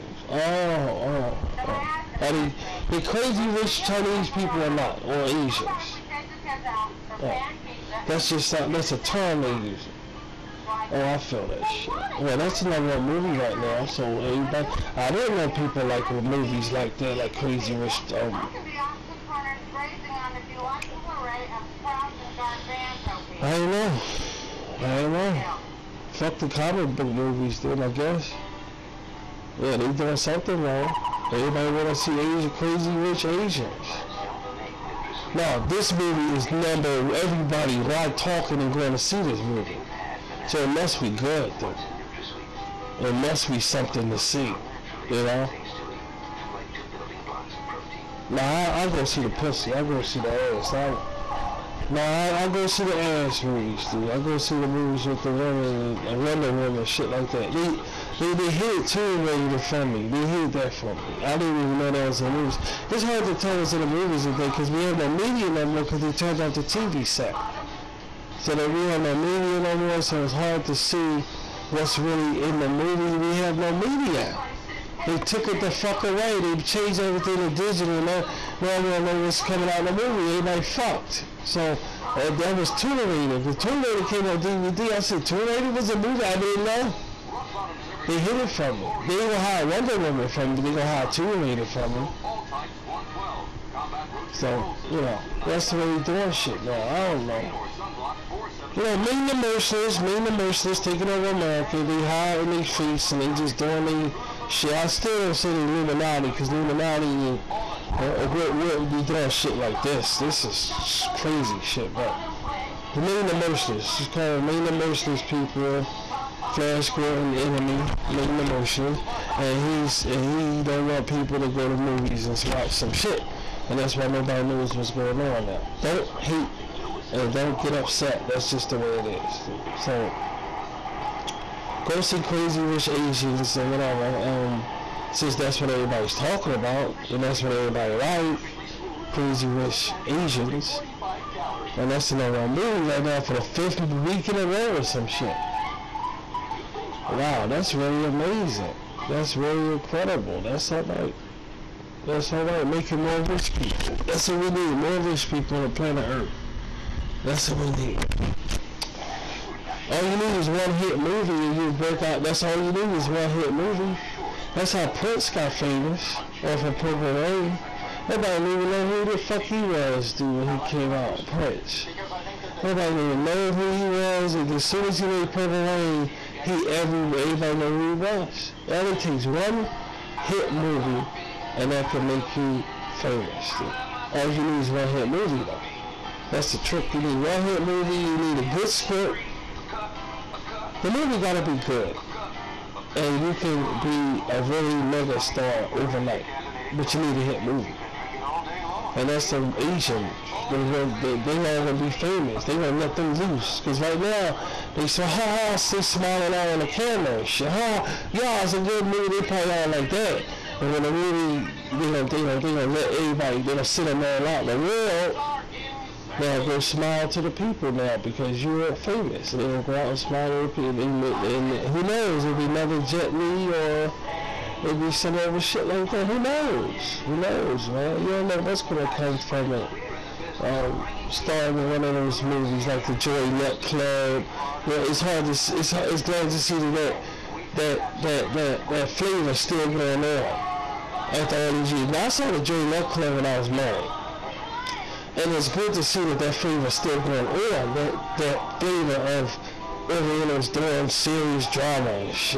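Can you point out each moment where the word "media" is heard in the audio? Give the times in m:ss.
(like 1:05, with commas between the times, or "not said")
1:05, 1:09, 1:13.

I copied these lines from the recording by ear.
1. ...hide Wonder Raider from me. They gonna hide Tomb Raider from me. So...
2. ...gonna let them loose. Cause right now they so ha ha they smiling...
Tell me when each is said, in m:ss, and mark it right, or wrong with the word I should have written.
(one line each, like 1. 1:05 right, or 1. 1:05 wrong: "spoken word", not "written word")
1. 1:29 wrong: "Woman", not "Raider"
2. 3:22 right.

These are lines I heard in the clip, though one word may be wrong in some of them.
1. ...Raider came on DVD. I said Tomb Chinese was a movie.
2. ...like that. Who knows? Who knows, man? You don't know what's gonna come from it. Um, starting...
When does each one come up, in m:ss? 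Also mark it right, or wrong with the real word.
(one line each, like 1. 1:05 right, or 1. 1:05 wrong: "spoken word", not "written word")
1. 1:23 wrong: "Raider", not "Chinese"
2. 3:45 right.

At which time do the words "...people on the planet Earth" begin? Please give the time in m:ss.
2:35.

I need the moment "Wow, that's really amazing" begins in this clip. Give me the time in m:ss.
2:27.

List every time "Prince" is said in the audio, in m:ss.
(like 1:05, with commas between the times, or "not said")
2:44, 2:51.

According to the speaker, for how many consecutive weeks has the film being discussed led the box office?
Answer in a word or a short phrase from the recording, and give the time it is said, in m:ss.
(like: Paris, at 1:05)
5, at 2:23.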